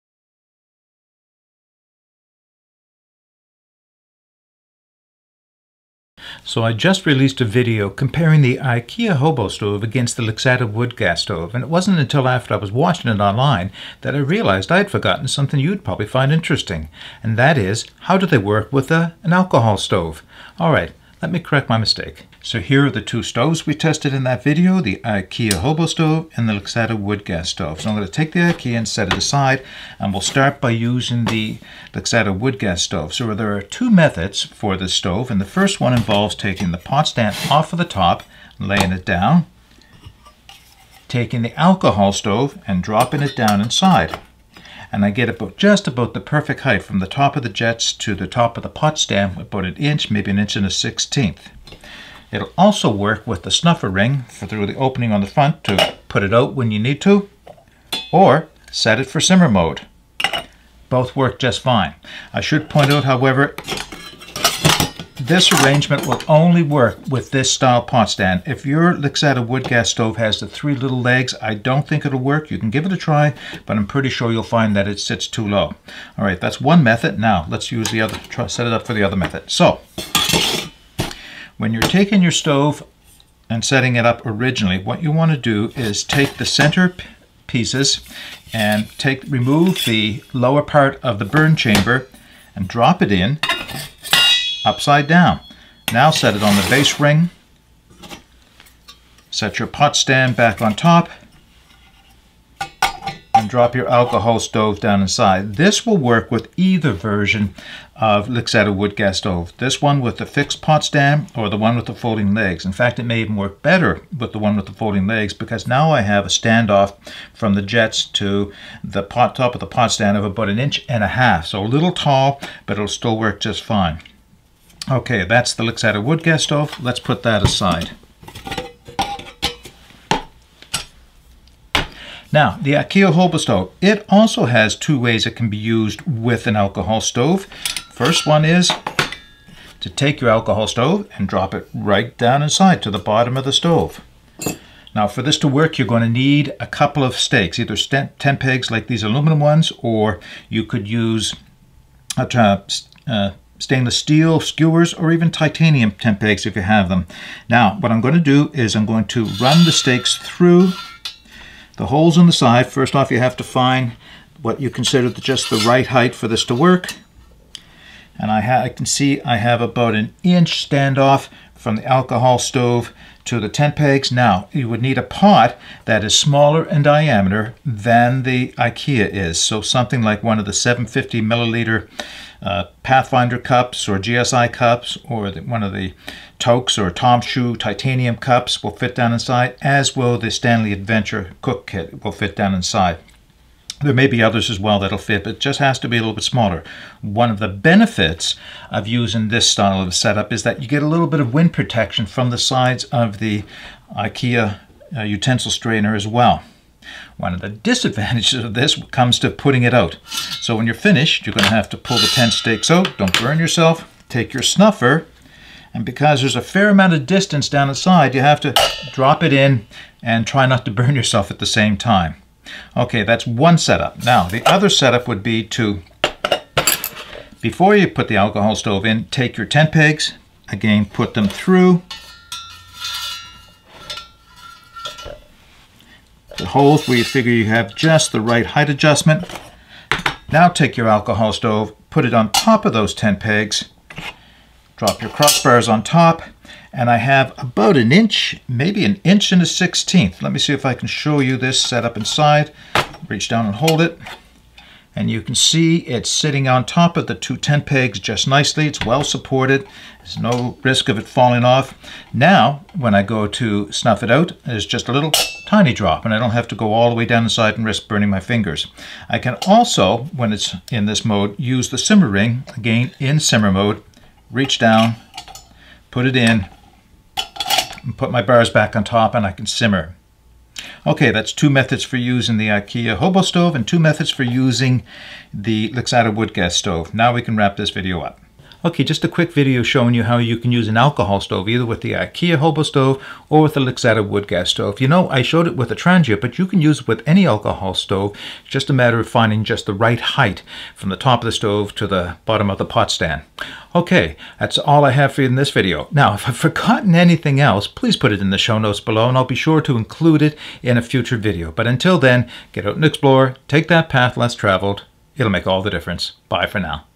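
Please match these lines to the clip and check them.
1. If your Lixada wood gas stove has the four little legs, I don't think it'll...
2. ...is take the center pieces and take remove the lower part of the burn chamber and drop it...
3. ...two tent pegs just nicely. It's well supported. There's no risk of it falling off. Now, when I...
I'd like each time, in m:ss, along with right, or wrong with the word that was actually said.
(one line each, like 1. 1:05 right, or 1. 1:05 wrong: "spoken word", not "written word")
1. 1:08 wrong: "three", not "four"
2. 1:25 right
3. 4:17 right.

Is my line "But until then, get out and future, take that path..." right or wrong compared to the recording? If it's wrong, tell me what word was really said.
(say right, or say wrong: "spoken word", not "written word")
wrong: "explore", not "future".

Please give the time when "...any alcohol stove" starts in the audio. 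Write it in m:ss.
4:57.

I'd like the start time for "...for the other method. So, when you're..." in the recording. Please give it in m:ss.
1:18.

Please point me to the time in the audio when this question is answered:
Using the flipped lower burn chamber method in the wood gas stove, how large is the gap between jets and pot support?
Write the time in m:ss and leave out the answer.
2:00.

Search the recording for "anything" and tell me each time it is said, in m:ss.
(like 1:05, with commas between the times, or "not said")
5:06.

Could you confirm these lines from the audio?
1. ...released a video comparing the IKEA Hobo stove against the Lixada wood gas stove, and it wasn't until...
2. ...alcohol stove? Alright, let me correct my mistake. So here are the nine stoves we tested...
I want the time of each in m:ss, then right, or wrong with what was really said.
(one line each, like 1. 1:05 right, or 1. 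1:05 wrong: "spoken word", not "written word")
1. 0:07 right
2. 0:19 wrong: "two", not "nine".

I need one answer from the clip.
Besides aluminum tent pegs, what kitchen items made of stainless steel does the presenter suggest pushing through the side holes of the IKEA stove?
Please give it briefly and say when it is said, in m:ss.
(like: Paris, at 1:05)
skewers, at 2:34.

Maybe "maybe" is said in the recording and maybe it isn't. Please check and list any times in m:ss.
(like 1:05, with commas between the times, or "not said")
0:50, 4:08.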